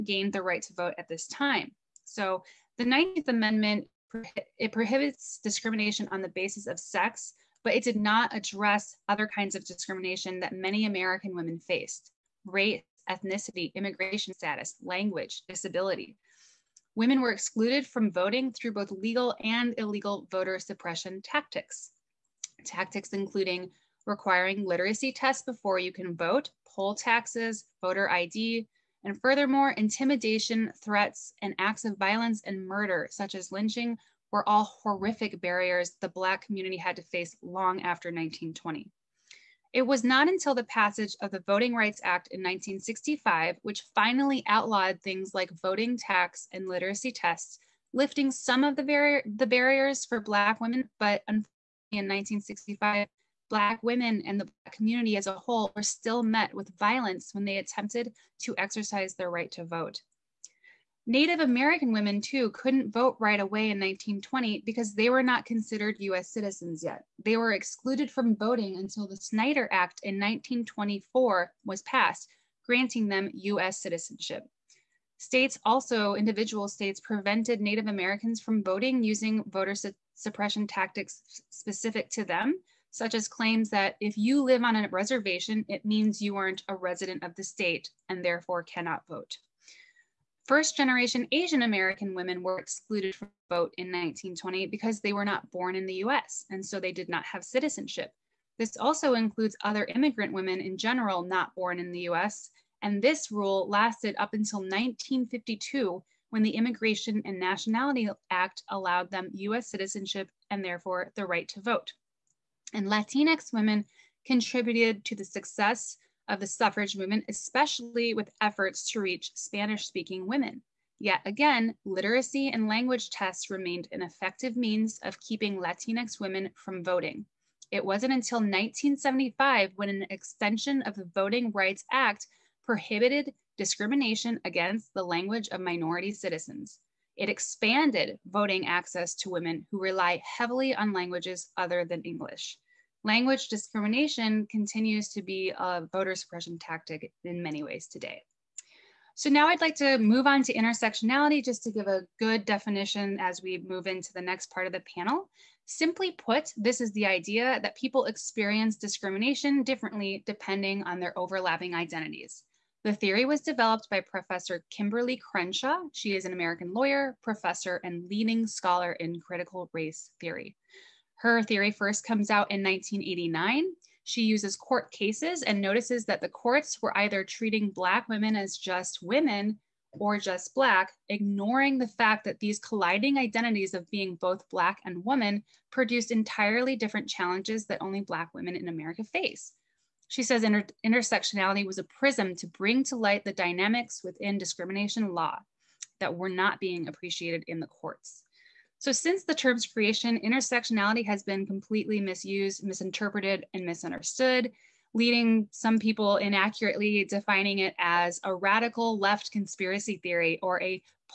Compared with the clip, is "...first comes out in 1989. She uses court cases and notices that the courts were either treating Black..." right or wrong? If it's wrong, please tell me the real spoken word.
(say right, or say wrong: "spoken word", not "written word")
right.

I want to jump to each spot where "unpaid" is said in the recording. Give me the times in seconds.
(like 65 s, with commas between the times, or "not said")
not said.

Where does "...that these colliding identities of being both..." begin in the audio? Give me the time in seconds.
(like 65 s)
182 s.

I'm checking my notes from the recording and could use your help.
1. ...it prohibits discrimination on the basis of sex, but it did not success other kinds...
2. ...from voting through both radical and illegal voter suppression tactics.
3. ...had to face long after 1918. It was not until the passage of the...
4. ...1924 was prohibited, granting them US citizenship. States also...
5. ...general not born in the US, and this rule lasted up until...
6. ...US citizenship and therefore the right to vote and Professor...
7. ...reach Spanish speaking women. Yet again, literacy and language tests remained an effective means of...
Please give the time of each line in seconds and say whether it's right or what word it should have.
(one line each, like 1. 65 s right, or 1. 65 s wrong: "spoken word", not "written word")
1. 4 s wrong: "address", not "success"
2. 17 s wrong: "legal", not "radical"
3. 36 s wrong: "1920", not "1918"
4. 70 s wrong: "passed", not "prohibited"
5. 100 s right
6. 109 s wrong: "Latinx", not "Professor"
7. 118 s right.